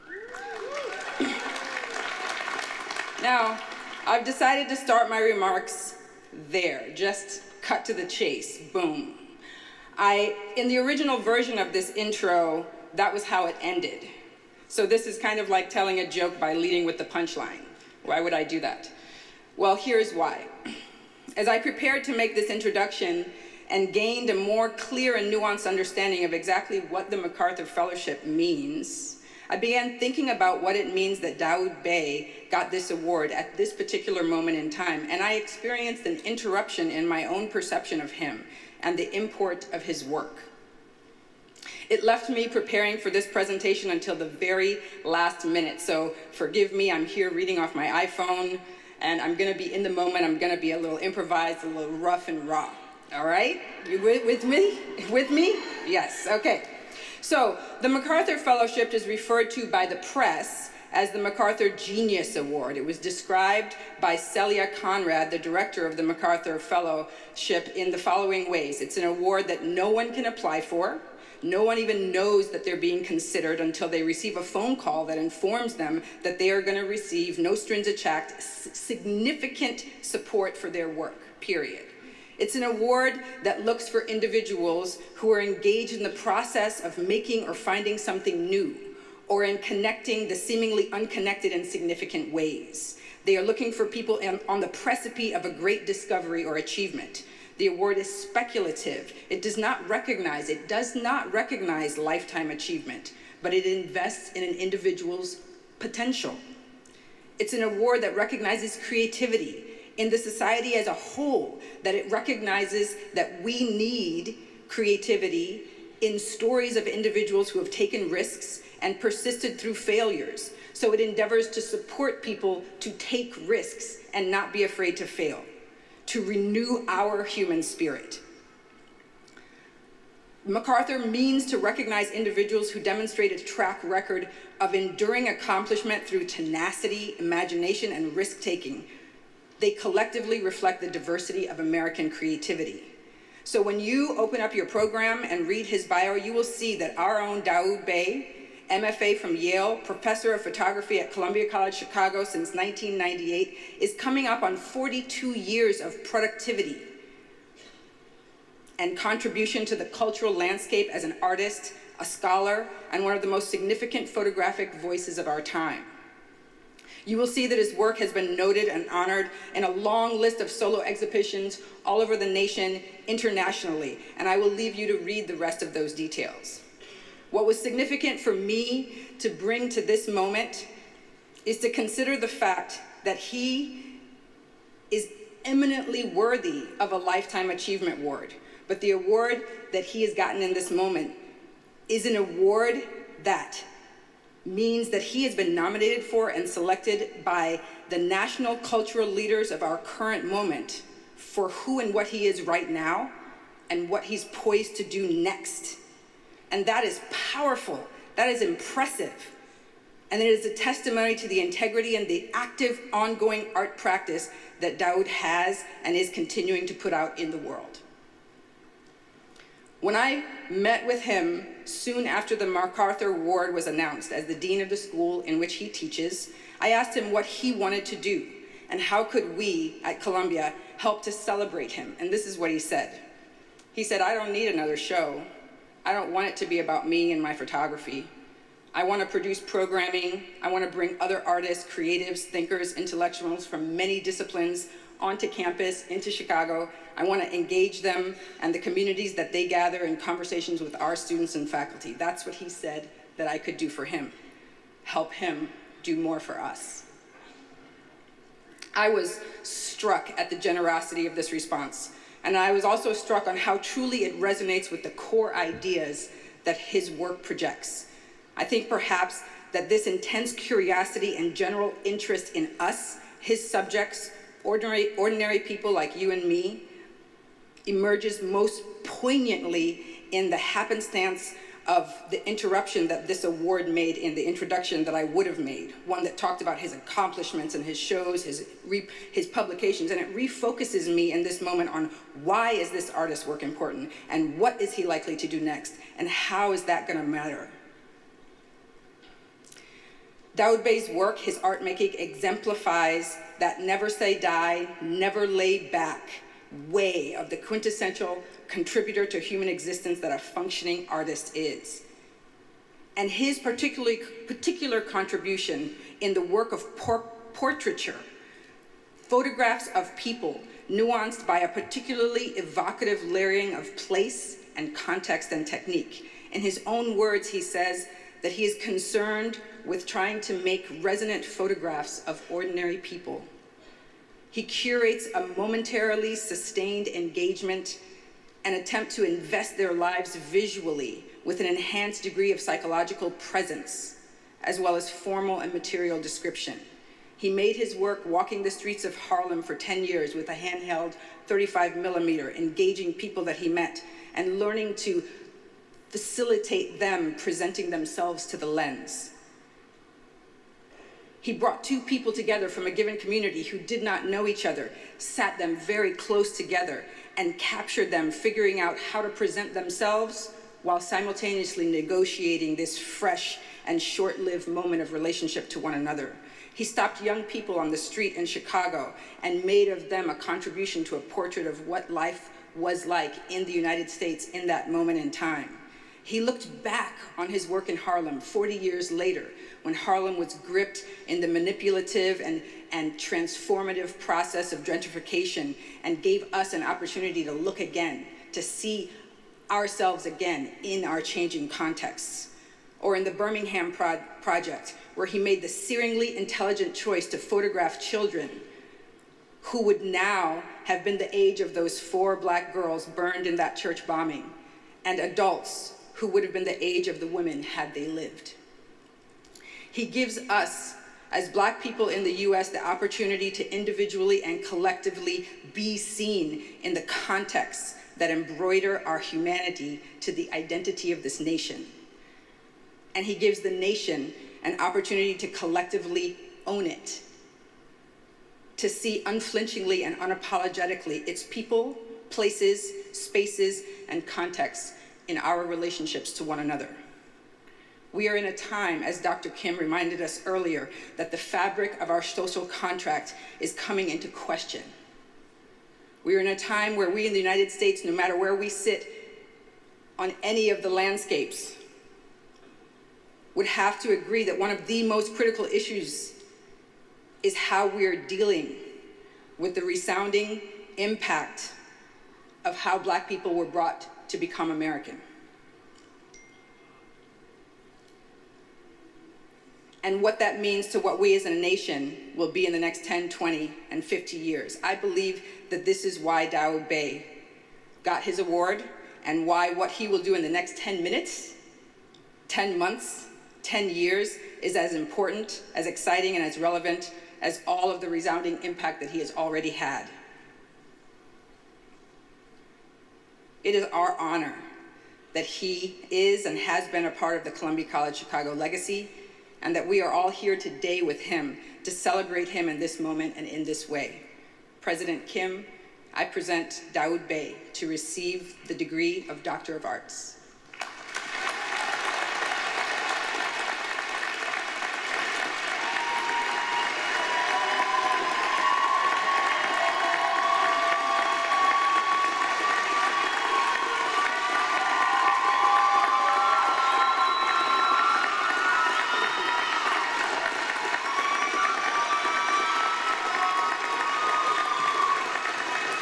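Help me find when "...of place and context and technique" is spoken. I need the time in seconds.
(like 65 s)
323 s.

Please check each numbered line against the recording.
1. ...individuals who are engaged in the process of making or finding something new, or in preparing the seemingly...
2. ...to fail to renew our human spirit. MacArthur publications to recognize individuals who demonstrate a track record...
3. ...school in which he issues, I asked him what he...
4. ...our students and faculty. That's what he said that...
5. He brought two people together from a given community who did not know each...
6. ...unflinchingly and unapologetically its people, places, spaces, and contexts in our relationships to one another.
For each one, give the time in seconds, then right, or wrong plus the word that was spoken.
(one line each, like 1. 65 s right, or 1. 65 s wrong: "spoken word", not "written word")
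1. 84 s wrong: "connecting", not "preparing"
2. 124 s wrong: "means", not "publications"
3. 224 s wrong: "teaches", not "issues"
4. 250 s right
5. 361 s right
6. 439 s right.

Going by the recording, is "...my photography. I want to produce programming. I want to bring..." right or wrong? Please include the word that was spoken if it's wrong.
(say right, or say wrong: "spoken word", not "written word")
right.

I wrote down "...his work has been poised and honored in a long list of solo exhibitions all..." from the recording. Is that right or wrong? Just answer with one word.
wrong.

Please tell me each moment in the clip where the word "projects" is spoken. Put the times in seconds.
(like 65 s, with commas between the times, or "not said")
267 s, 404 s.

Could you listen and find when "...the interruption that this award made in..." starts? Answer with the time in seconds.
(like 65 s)
282 s.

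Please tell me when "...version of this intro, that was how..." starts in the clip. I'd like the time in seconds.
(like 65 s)
11 s.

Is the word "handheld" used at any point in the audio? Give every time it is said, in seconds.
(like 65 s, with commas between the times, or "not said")
350 s.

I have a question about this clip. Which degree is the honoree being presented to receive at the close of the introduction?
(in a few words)
Doctor of Arts.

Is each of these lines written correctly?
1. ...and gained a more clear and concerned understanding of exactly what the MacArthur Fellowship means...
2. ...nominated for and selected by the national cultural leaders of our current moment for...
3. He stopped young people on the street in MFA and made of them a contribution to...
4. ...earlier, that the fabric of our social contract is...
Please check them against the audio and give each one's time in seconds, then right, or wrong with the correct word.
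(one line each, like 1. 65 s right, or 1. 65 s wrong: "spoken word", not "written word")
1. 23 s wrong: "nuanced", not "concerned"
2. 195 s right
3. 376 s wrong: "Chicago", not "MFA"
4. 450 s right.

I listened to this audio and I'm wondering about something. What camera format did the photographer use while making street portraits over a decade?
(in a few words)
35 millimeter.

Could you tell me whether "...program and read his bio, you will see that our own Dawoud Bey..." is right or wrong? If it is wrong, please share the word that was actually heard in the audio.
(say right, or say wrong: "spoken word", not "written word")
right.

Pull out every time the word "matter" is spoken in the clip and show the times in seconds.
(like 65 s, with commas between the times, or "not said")
297 s, 457 s.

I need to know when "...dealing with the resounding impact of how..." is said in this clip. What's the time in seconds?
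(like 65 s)
467 s.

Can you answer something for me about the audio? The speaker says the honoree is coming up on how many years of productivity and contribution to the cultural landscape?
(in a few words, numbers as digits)
42.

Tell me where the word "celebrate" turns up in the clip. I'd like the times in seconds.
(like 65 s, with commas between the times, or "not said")
231 s, 511 s.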